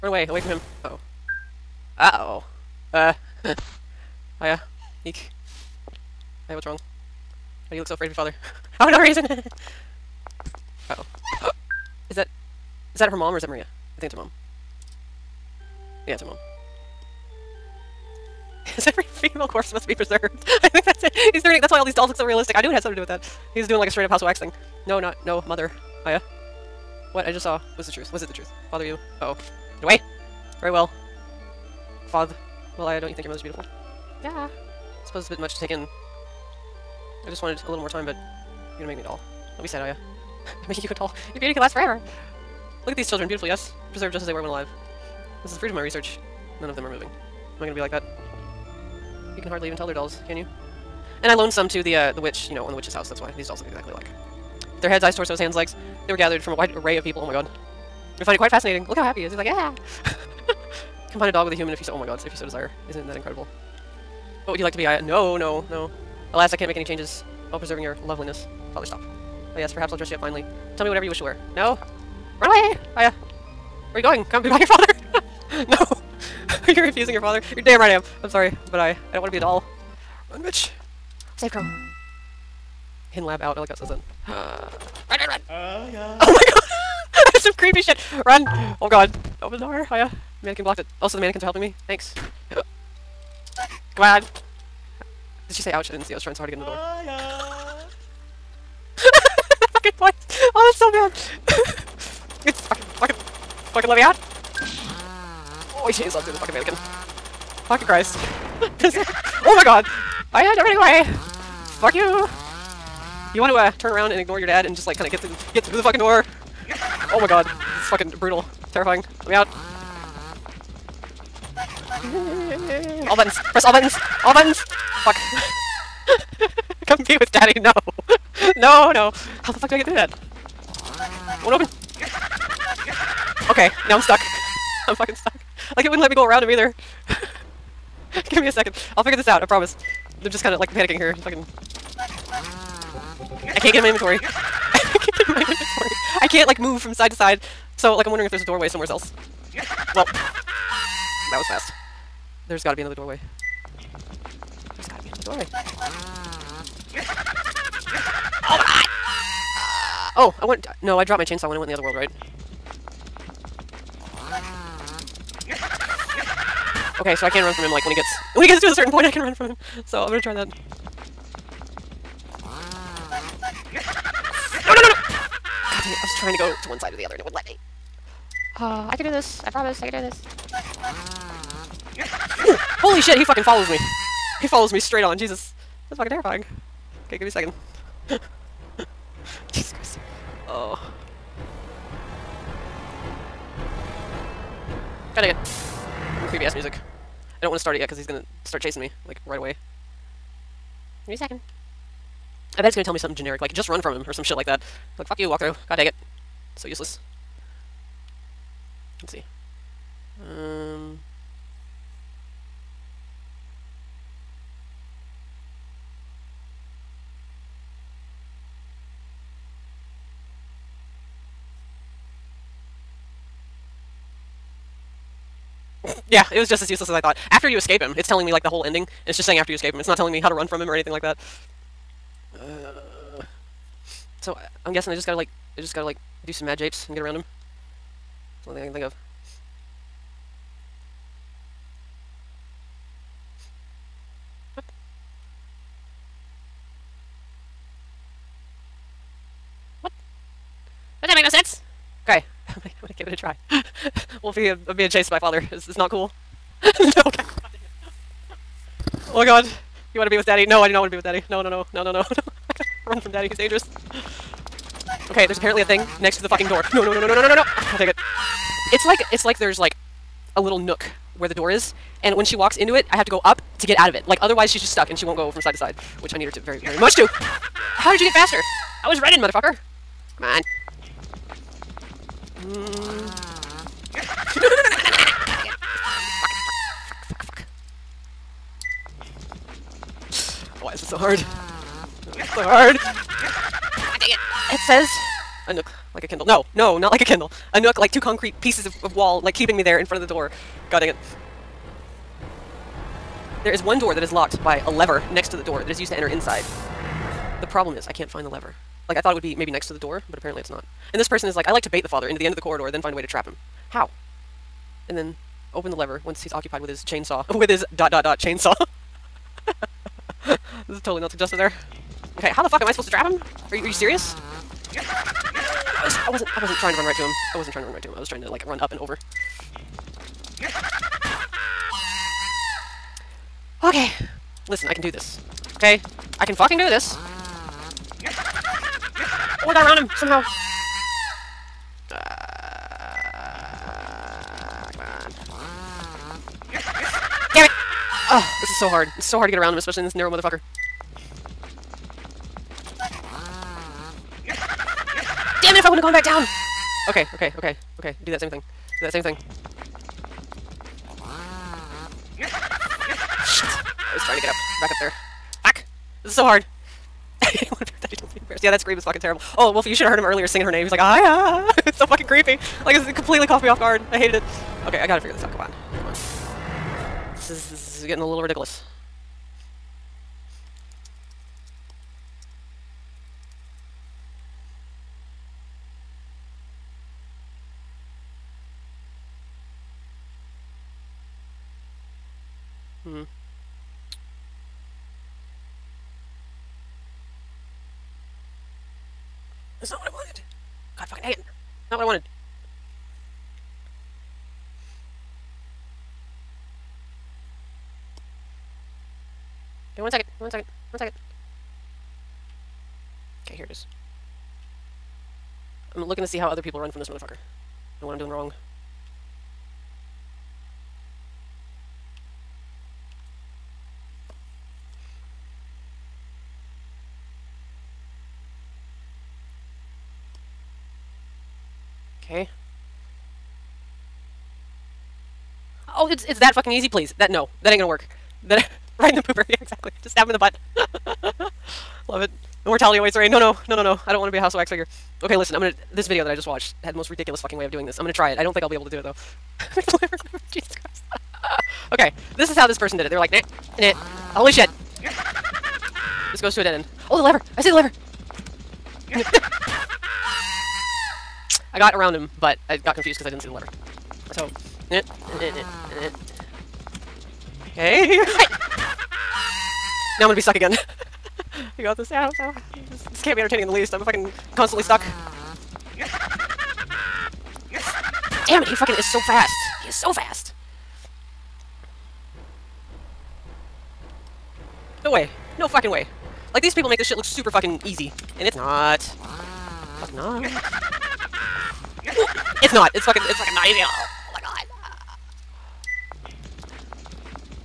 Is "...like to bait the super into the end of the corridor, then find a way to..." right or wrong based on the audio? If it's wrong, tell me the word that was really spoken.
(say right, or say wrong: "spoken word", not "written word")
wrong: "father", not "super".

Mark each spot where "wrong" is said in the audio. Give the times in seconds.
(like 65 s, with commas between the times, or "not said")
6 s, 418 s.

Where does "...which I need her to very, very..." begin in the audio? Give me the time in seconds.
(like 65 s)
276 s.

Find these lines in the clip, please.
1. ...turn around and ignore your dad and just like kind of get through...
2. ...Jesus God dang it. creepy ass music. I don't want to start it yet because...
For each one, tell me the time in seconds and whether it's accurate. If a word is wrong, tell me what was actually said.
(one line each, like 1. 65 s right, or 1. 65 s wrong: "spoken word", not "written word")
1. 113 s right
2. 189 s right.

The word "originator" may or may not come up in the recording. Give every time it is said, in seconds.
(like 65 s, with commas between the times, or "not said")
not said.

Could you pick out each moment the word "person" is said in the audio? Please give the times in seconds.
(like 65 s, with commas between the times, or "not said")
311 s, 452 s.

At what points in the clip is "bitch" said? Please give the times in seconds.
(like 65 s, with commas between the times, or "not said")
80 s.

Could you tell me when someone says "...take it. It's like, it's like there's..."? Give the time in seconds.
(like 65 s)
267 s.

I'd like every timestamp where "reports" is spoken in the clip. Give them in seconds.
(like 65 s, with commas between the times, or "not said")
not said.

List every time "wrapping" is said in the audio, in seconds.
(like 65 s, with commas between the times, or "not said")
not said.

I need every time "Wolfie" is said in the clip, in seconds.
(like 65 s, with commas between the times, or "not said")
254 s, 369 s.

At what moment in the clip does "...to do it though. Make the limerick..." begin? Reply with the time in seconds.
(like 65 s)
448 s.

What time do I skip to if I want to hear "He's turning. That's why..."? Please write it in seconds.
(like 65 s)
21 s.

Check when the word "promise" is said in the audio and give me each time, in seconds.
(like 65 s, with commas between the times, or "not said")
139 s, 179 s.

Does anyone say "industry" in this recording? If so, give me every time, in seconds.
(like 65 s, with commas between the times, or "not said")
not said.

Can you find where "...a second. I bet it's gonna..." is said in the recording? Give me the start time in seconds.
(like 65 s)
201 s.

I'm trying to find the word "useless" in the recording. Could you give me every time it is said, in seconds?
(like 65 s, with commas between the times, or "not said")
206 s, 226 s.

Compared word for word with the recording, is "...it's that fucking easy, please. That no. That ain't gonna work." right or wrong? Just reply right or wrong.
right.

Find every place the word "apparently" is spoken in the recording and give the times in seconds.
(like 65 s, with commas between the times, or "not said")
265 s, 310 s.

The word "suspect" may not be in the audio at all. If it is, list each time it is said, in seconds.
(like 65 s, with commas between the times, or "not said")
not said.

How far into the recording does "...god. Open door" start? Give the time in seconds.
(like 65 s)
88 s.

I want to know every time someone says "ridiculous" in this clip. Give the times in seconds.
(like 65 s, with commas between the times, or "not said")
378 s, 446 s.